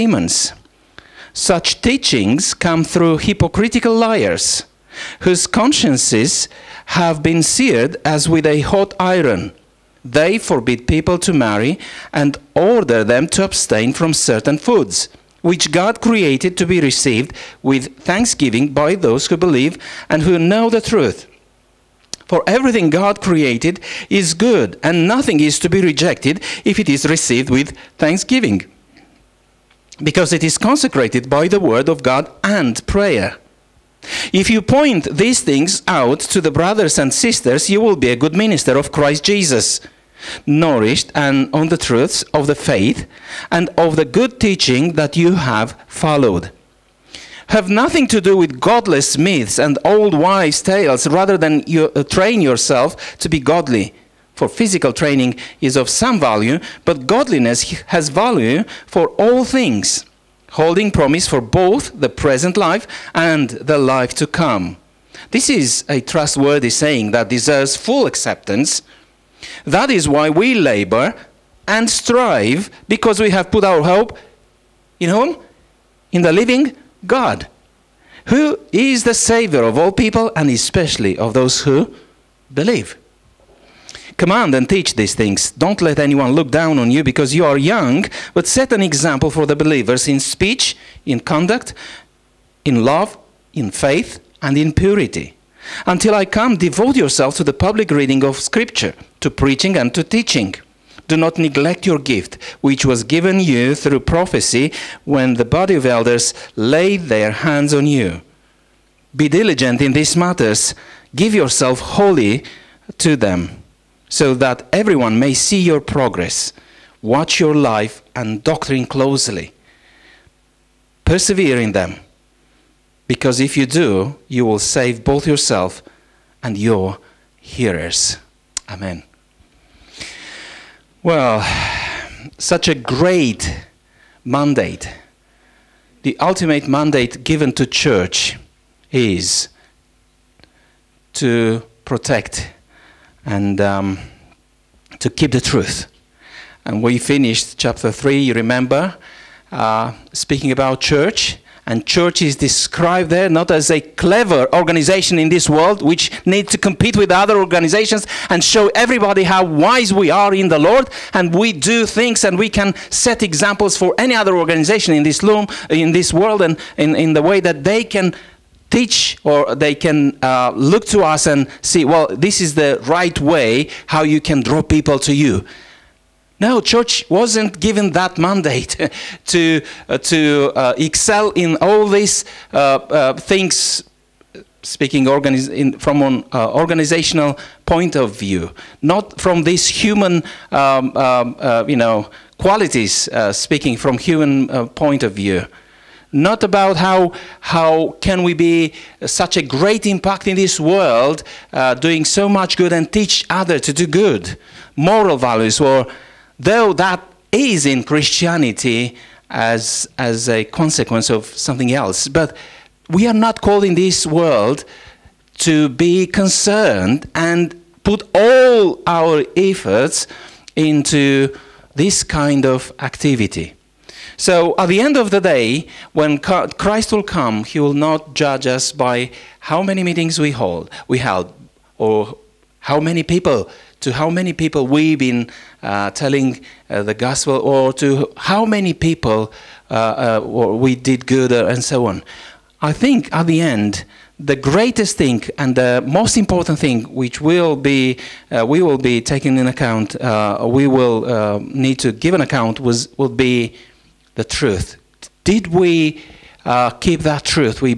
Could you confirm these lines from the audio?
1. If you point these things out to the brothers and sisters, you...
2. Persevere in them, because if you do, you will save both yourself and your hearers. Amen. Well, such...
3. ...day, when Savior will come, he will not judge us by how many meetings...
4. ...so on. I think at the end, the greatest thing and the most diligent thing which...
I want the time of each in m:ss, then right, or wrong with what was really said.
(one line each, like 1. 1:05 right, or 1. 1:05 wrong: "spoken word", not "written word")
1. 0:34 right
2. 2:01 right
3. 3:45 wrong: "Christ", not "Savior"
4. 4:01 wrong: "important", not "diligent".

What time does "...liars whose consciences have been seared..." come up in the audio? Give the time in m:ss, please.
0:03.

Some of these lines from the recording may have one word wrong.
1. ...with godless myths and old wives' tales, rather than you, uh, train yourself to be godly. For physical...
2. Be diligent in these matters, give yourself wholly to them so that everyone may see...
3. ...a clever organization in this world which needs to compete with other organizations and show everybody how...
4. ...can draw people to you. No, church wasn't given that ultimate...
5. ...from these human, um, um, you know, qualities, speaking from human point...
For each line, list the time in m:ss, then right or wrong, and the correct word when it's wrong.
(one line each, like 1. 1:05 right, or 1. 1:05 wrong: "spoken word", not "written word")
1. 0:48 right
2. 1:49 right
3. 2:33 right
4. 2:54 wrong: "mandate", not "ultimate"
5. 3:09 right.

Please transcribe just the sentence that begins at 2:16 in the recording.
The ultimate mandate given to church is to protect and um, to keep the truth.